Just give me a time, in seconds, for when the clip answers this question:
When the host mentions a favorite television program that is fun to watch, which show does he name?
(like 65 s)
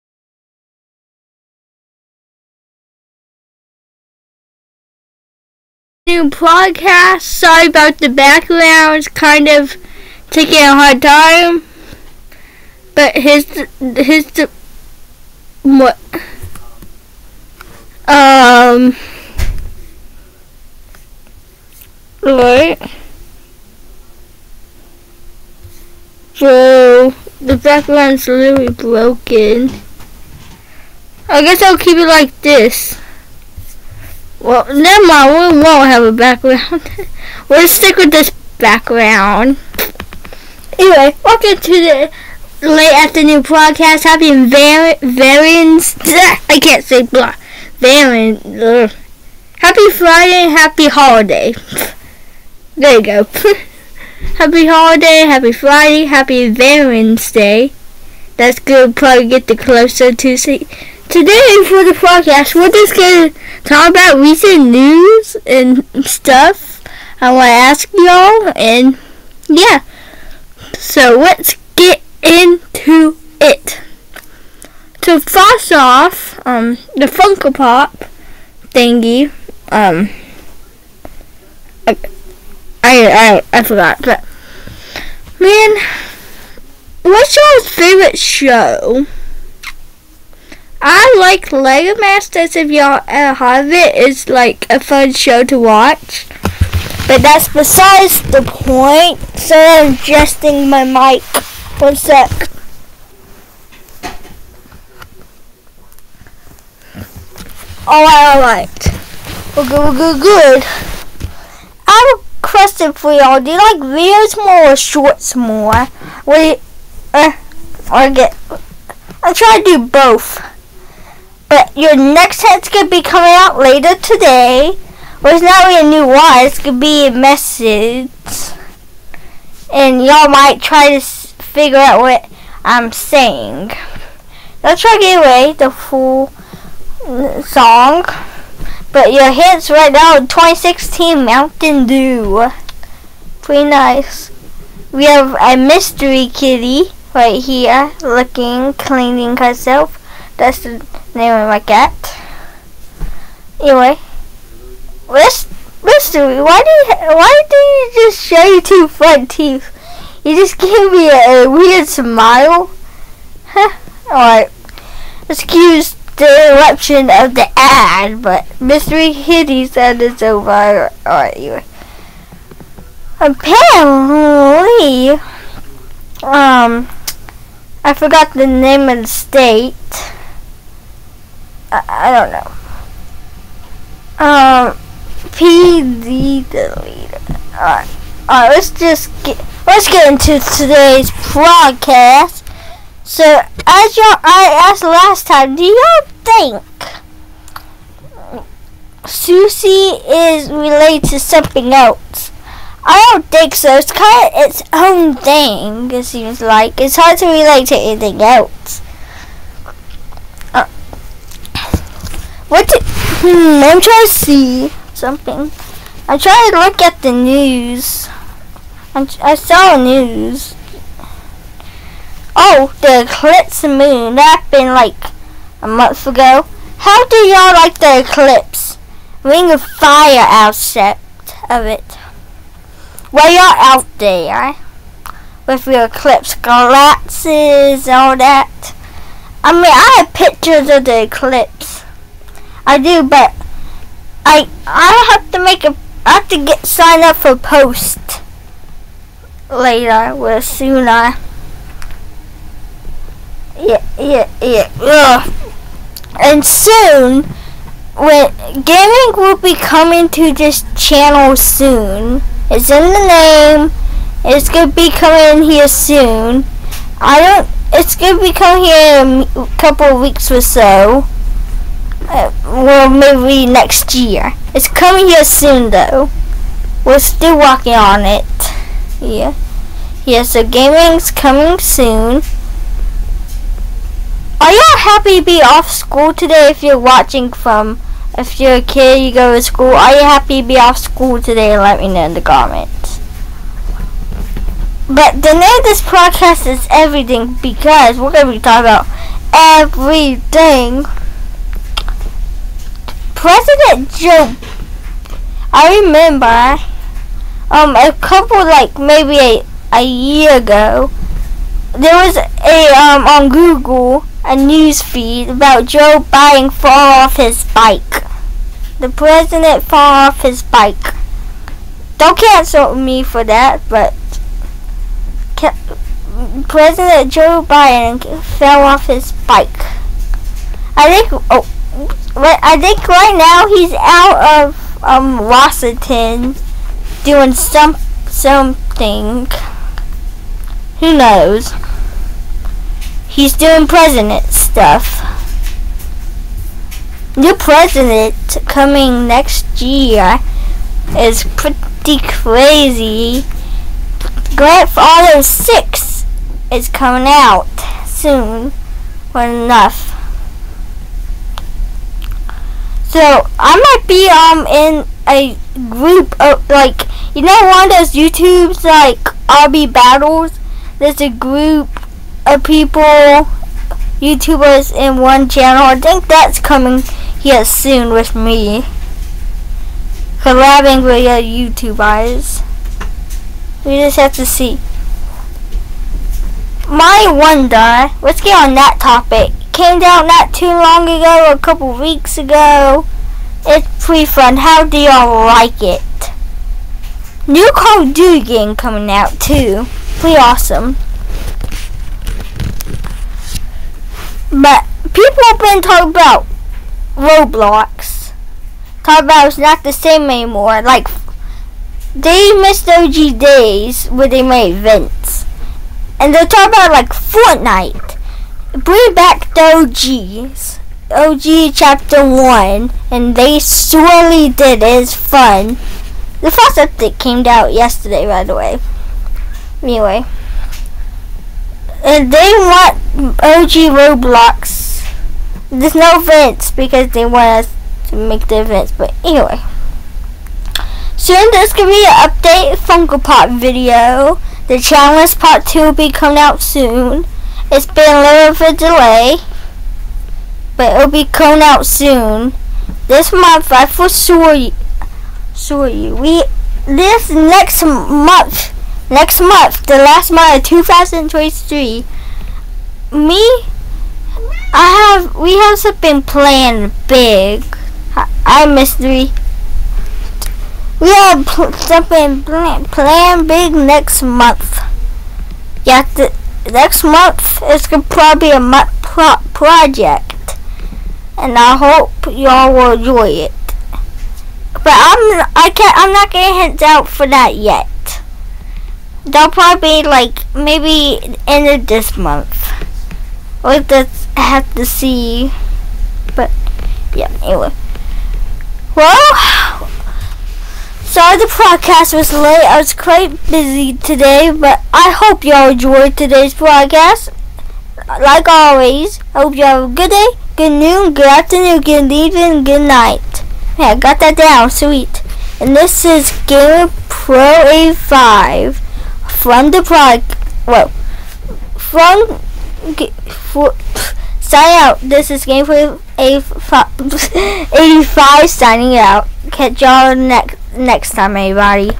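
91 s.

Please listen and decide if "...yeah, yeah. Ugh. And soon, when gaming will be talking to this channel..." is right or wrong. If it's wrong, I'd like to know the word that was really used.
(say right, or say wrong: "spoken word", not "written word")
wrong: "coming", not "talking".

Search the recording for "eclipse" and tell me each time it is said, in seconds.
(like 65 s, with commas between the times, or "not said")
223 s, 228 s, 235 s, 241 s.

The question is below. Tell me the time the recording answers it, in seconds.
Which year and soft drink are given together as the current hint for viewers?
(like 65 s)
140 s.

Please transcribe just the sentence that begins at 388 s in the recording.
Let's get on that topic came out not too long ago, a couple weeks ago.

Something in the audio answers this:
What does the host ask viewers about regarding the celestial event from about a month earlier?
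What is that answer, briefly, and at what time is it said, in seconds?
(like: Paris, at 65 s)
Ring of fire, at 229 s.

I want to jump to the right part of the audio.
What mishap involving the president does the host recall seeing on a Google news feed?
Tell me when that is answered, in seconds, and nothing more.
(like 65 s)
328 s.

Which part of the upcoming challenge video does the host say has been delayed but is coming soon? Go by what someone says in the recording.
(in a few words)
Part 2.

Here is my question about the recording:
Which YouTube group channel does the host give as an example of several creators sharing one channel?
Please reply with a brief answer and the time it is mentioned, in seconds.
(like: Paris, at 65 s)
RB Battles, at 369 s.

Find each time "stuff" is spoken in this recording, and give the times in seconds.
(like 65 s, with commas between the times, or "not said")
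66 s, 344 s.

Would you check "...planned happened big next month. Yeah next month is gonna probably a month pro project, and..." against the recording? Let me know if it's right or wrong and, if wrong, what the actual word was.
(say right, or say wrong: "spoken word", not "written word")
wrong: "planned", not "happened".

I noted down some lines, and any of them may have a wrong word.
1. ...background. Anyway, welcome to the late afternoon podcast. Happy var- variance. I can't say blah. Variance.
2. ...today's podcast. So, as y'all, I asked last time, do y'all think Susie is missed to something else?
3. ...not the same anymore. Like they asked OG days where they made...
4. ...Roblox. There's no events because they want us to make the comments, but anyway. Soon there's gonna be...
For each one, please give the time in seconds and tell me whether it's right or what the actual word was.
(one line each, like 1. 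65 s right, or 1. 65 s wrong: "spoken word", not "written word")
1. 38 s right
2. 190 s wrong: "related", not "missed"
3. 409 s wrong: "missed", not "asked"
4. 433 s wrong: "events", not "comments".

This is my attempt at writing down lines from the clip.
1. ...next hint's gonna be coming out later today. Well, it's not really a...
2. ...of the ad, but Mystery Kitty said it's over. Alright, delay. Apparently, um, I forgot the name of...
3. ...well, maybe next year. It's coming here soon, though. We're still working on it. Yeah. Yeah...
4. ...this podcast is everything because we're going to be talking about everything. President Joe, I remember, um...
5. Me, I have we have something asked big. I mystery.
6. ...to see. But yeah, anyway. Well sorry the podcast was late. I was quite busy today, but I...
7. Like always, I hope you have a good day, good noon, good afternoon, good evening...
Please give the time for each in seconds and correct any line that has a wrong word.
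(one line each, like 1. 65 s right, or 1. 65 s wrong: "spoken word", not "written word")
1. 121 s right
2. 167 s wrong: "anyway", not "delay"
3. 272 s right
4. 295 s right
5. 462 s wrong: "planned", not "asked"
6. 494 s right
7. 507 s right.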